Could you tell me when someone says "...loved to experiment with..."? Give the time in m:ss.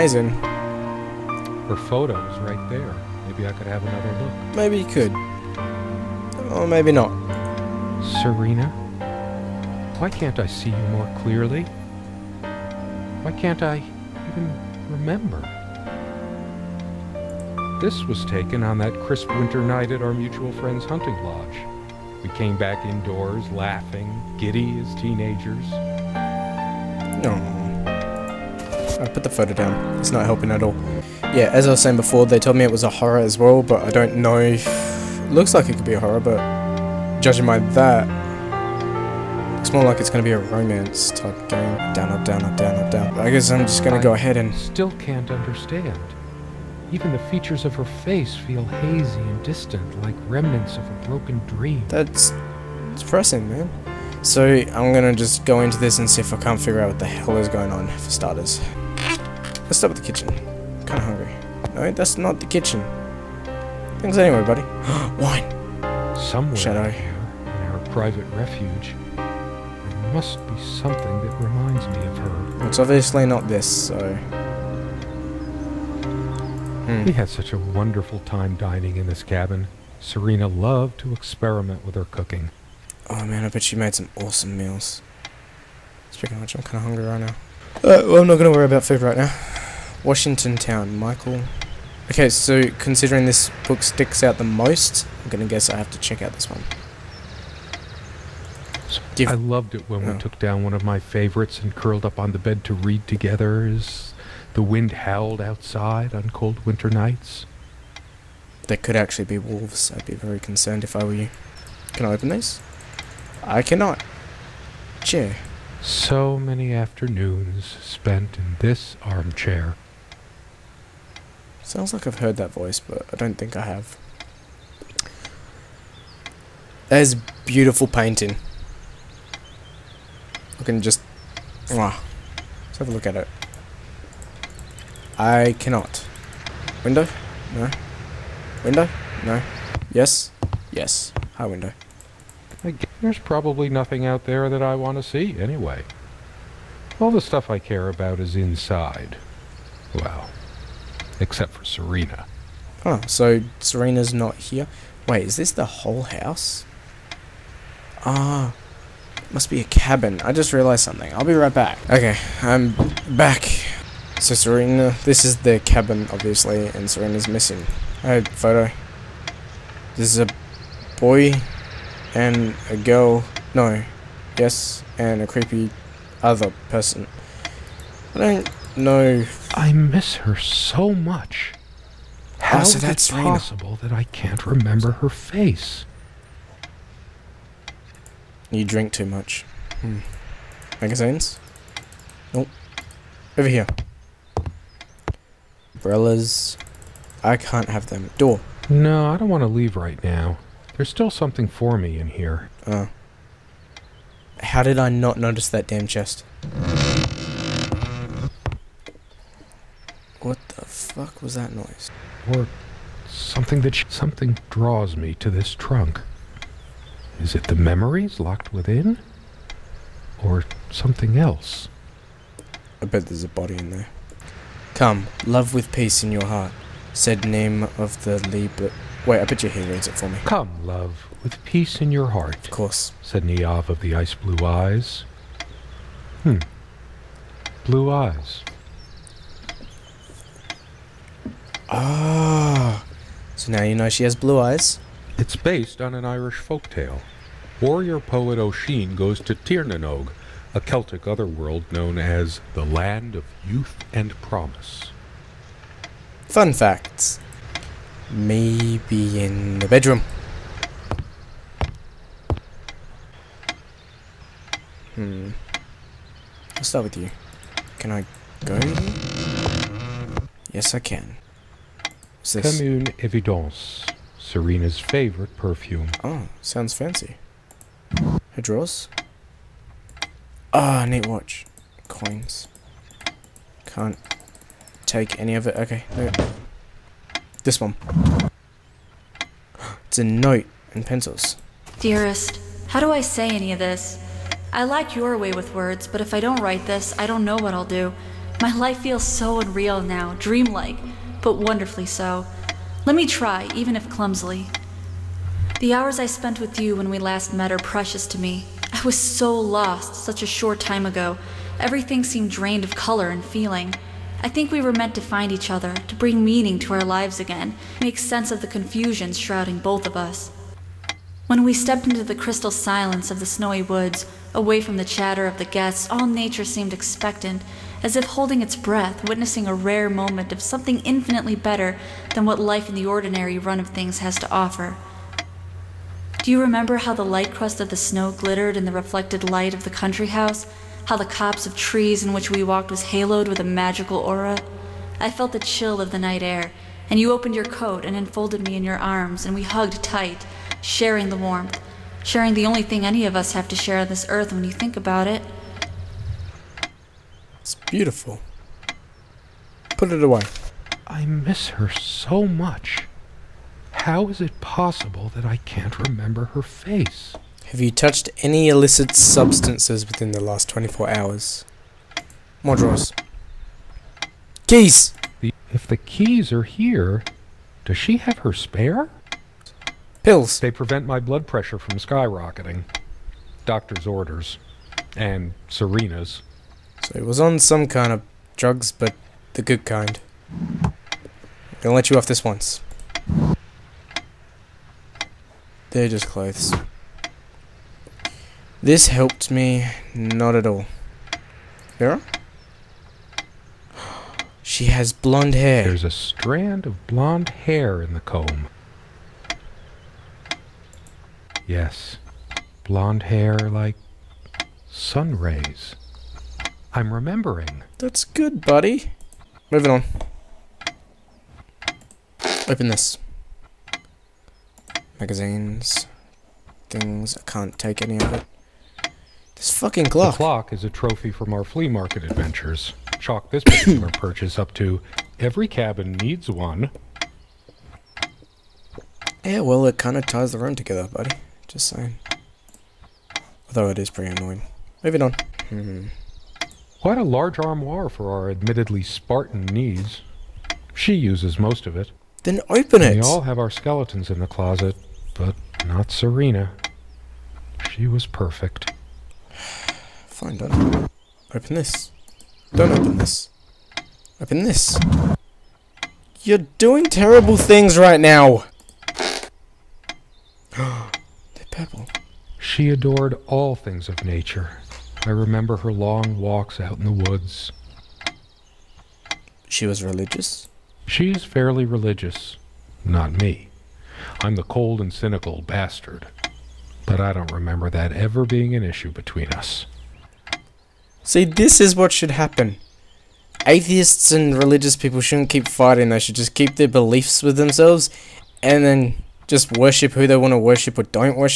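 1:20.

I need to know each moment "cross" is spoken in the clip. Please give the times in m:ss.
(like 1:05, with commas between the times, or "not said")
not said.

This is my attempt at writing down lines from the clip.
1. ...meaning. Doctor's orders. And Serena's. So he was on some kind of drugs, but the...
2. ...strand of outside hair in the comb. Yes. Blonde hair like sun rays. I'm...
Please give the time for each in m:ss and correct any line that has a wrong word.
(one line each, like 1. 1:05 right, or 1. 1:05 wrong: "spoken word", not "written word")
1. 6:21 wrong: "skyrocketing", not "meaning"
2. 6:45 wrong: "blonde", not "outside".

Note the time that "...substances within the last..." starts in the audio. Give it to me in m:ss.
6:08.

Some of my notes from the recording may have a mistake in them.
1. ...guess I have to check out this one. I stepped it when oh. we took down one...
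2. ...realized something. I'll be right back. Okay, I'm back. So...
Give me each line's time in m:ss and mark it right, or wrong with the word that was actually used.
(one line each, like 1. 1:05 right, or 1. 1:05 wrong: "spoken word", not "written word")
1. 1:35 wrong: "loved", not "stepped"
2. 2:40 right.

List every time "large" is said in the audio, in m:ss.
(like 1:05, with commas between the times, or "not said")
7:27.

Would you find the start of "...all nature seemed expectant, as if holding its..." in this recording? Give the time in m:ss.
5:25.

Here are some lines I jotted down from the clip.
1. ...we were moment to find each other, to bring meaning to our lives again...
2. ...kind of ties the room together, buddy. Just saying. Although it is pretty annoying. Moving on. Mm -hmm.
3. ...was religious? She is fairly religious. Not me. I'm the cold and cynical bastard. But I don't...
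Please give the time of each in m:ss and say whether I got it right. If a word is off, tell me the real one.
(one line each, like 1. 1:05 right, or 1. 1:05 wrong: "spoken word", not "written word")
1. 5:14 wrong: "meant", not "moment"
2. 7:19 right
3. 7:59 right.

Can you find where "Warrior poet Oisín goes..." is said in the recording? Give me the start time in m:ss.
4:07.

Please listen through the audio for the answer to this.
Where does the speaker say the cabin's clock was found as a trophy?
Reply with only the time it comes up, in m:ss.
7:11.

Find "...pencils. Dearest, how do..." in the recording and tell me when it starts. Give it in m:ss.
4:50.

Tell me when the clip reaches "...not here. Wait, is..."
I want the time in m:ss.
2:34.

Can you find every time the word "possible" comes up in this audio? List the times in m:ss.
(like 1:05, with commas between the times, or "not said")
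3:03, 6:04.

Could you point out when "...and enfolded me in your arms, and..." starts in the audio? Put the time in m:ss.
5:47.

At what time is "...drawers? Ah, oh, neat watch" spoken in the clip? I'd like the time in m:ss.
4:38.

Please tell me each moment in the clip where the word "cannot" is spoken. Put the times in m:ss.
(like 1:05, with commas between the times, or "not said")
1:53, 2:15.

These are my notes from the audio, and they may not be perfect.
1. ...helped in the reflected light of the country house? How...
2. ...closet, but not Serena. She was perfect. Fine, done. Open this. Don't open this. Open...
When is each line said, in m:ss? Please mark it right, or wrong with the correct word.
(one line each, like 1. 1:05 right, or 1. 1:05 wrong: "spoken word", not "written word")
1. 5:38 wrong: "glittered", not "helped"
2. 7:34 right.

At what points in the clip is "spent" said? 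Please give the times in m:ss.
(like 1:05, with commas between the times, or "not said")
1:57, 5:06.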